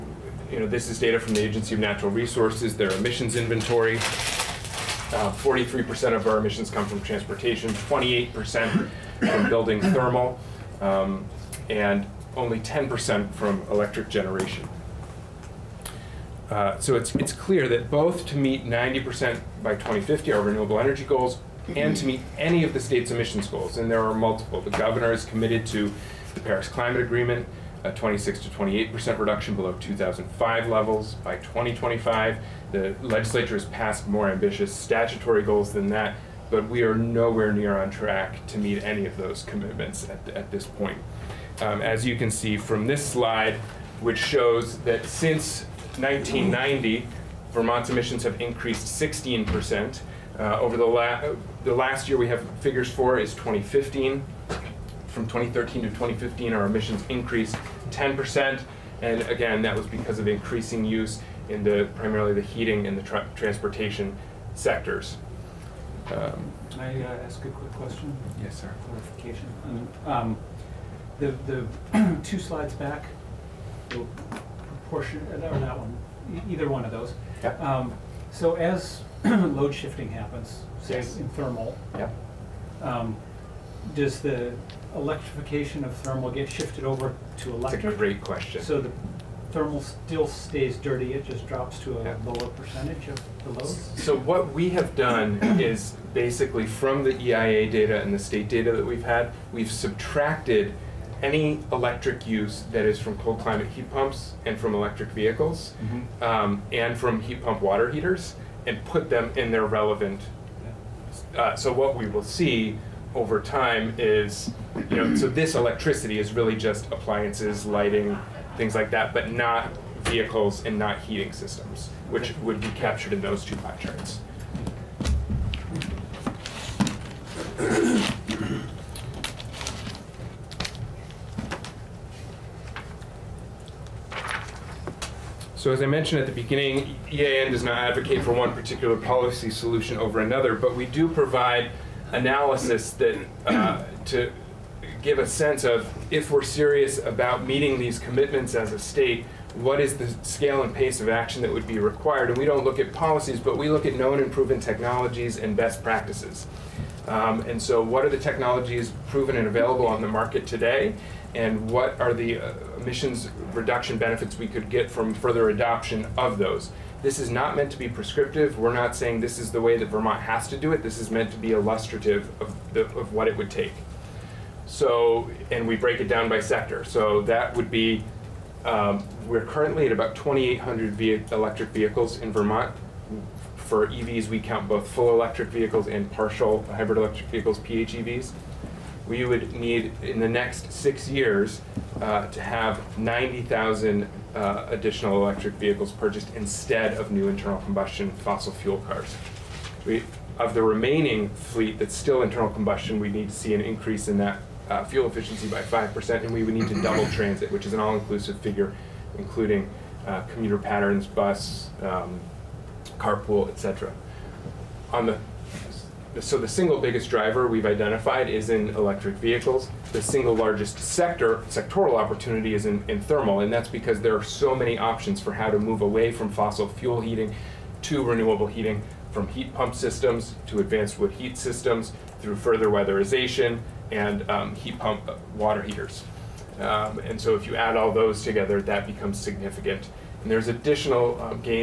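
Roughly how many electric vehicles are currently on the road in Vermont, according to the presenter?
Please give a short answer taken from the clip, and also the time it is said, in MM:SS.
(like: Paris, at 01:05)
2,800, at 03:00.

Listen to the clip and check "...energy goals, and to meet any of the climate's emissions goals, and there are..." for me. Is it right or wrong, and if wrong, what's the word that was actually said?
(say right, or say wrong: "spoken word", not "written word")
wrong: "state", not "climate".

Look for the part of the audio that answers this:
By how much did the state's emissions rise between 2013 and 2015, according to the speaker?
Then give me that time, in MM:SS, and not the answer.
00:57.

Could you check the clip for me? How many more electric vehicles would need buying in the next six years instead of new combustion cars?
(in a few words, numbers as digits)
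90,000.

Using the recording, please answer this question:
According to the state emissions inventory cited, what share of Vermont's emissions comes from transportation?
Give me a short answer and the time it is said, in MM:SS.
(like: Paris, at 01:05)
43%, at 00:05.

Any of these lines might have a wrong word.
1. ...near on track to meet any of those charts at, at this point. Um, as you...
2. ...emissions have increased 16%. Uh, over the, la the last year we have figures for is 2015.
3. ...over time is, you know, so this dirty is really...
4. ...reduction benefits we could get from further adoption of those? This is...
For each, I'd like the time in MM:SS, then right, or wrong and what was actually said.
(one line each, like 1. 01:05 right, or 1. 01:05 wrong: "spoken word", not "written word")
1. 00:37 wrong: "commitments", not "charts"
2. 00:47 right
3. 01:53 wrong: "electricity", not "dirty"
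4. 02:43 right.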